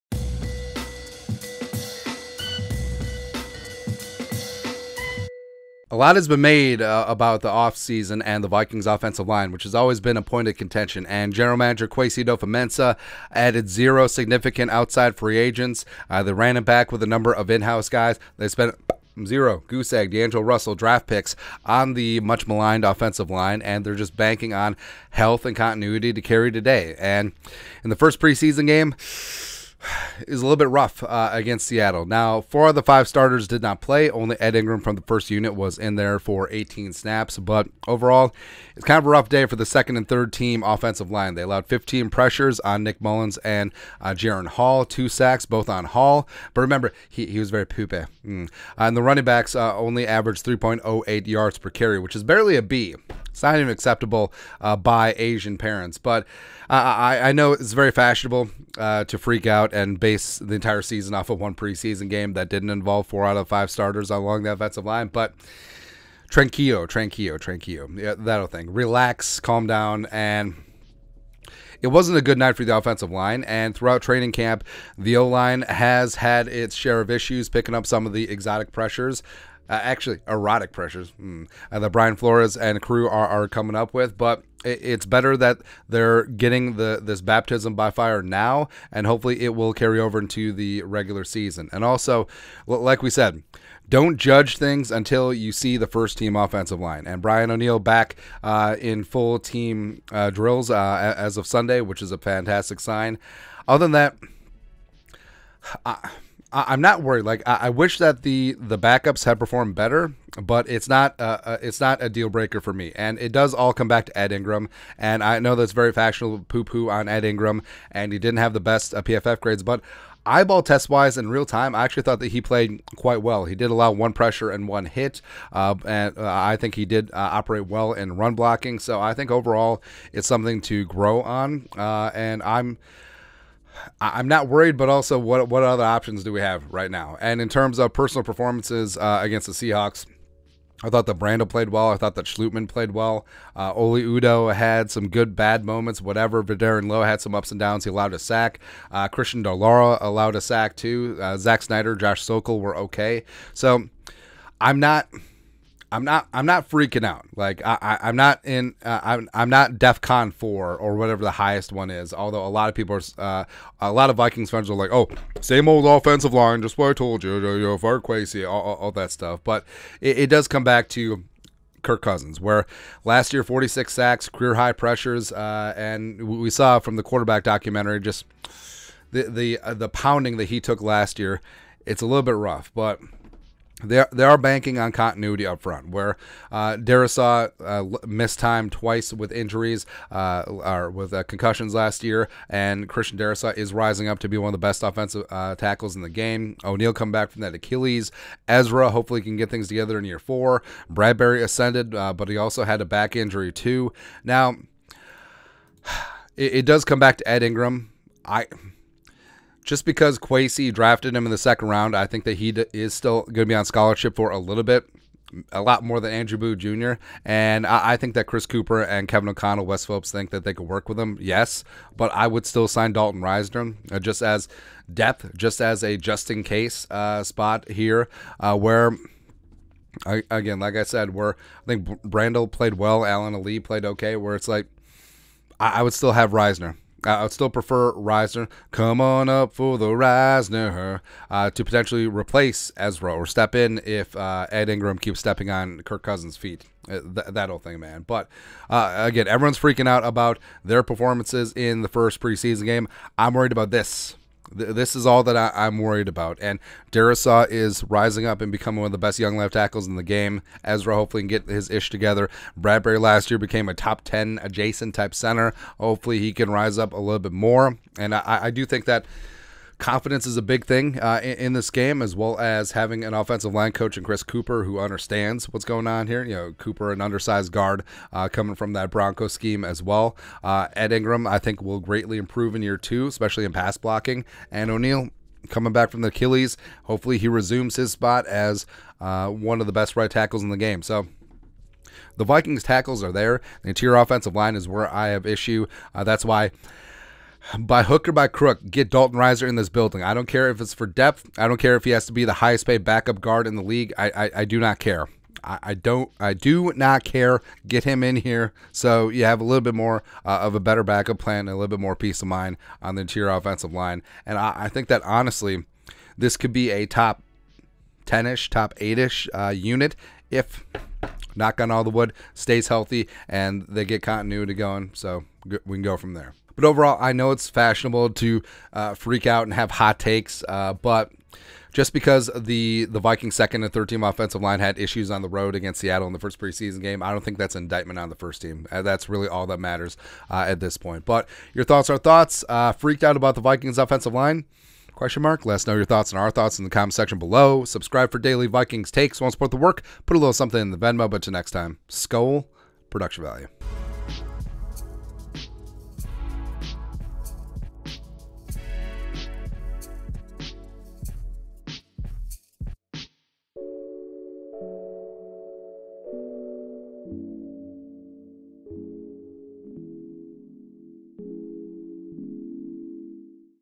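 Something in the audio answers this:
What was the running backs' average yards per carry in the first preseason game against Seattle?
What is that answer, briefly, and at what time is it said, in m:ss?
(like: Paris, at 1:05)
3.08, at 0:50.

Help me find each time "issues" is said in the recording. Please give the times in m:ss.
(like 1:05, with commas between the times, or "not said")
1:17, 4:55, 5:34.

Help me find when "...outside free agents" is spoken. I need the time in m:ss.
0:14.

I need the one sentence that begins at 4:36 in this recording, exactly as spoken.
You know, Cooper, an undersized guard, uh, coming from that Bronco scheme as well.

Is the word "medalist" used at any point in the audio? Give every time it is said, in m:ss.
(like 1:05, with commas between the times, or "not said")
not said.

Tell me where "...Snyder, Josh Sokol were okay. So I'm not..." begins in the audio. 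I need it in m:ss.
2:31.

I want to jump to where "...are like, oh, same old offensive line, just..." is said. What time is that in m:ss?
2:44.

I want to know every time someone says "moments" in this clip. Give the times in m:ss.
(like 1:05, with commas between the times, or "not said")
2:25.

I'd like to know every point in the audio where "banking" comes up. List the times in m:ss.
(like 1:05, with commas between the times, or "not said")
0:24, 3:04.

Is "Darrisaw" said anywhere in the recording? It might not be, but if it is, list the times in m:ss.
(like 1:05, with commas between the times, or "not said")
3:06, 3:13, 4:16.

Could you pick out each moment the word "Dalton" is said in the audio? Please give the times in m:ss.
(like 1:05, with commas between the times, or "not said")
3:42, 4:58.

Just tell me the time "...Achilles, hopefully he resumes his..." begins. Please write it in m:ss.
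4:46.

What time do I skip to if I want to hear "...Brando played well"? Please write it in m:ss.
2:21.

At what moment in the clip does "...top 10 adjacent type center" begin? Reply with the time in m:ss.
4:23.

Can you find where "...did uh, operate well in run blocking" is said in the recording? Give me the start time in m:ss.
2:06.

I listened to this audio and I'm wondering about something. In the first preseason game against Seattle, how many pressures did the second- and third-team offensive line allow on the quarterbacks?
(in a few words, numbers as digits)
15.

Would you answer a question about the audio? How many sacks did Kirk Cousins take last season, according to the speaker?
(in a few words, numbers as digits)
46.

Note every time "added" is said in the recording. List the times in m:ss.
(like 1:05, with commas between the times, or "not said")
0:13.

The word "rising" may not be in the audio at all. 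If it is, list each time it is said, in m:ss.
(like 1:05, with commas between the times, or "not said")
3:13, 4:17.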